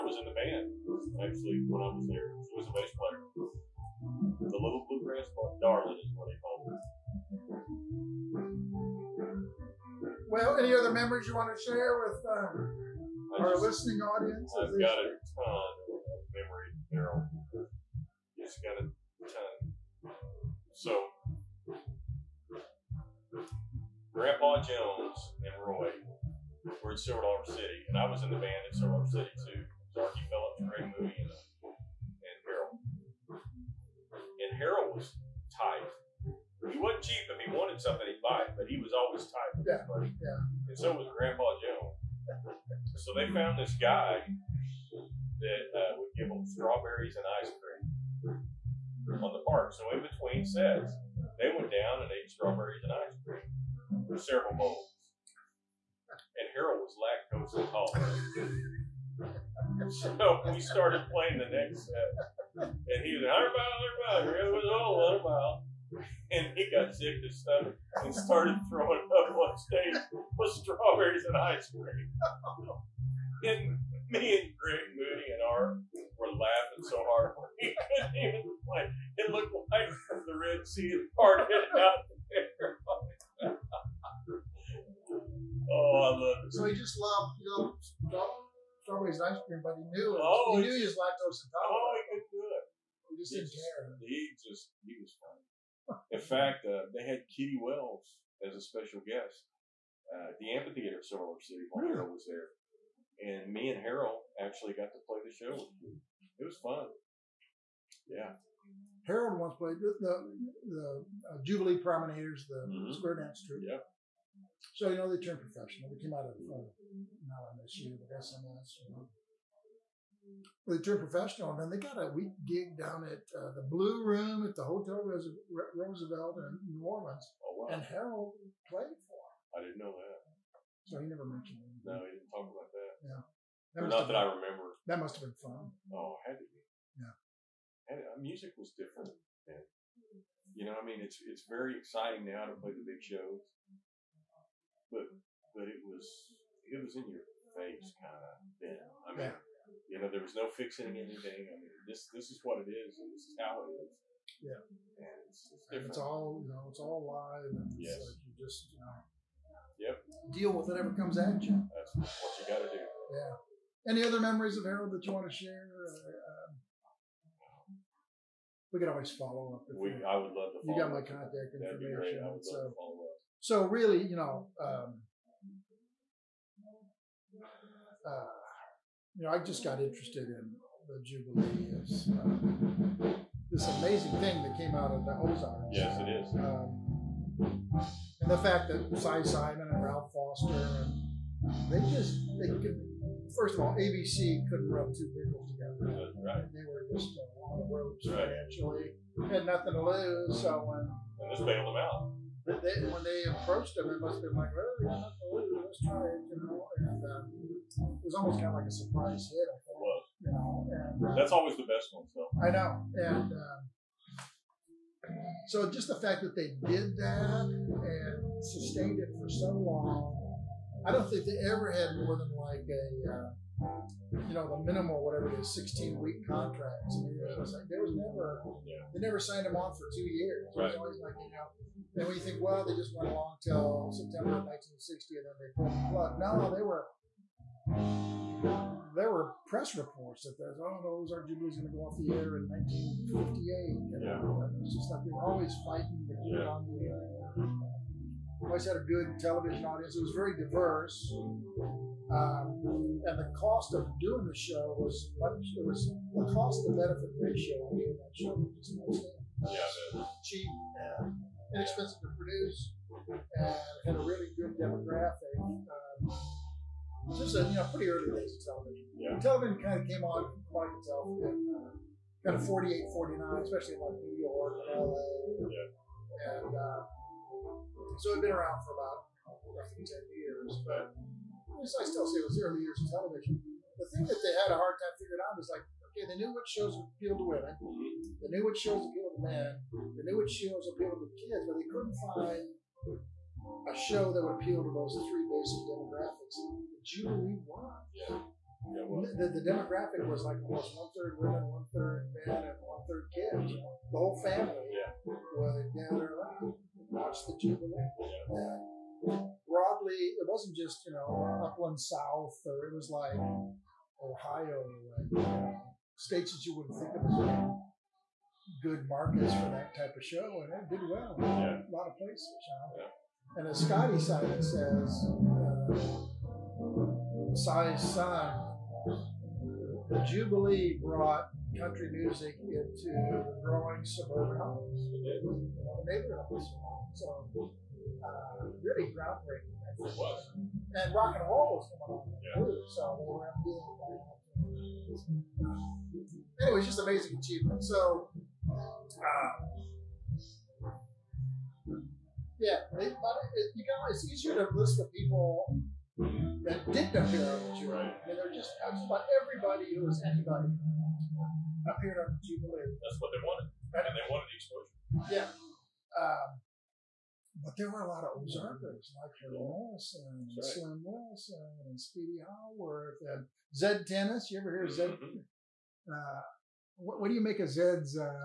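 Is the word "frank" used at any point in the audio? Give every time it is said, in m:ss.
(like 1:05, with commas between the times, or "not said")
not said.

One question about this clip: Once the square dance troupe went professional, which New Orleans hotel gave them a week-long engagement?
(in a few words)
Hotel Roosevelt.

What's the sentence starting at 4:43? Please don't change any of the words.
The thing that they had a hard time figuring out is like Okay, mm-hmm.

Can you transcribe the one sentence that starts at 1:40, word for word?
Uh, the amphitheater at Silver Lake City when Harold was there.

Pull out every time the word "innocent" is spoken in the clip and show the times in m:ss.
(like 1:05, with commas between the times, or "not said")
not said.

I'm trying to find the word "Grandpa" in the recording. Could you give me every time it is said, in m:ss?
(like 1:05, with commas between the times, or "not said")
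0:24, 0:41.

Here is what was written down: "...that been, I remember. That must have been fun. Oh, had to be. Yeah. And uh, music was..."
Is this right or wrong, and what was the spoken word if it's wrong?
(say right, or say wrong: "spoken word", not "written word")
right.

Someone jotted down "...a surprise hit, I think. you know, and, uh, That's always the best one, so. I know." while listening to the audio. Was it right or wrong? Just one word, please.
right.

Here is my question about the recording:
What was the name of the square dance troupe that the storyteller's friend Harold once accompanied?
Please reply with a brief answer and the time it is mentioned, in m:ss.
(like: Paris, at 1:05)
Jubilee Promenaders, at 1:51.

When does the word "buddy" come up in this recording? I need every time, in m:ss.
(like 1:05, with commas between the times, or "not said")
0:39.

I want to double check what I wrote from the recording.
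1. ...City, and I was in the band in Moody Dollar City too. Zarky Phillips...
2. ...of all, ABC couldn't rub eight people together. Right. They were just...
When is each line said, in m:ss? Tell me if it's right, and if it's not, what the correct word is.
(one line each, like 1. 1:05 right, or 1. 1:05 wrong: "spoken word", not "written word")
1. 0:27 wrong: "Silver", not "Moody"
2. 3:13 wrong: "two", not "eight".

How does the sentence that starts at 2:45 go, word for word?
Uh, we could always follow up.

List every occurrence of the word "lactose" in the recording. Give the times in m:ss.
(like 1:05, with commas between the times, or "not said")
0:57, 1:30.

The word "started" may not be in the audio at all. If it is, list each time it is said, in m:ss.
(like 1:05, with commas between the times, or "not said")
1:00, 1:08.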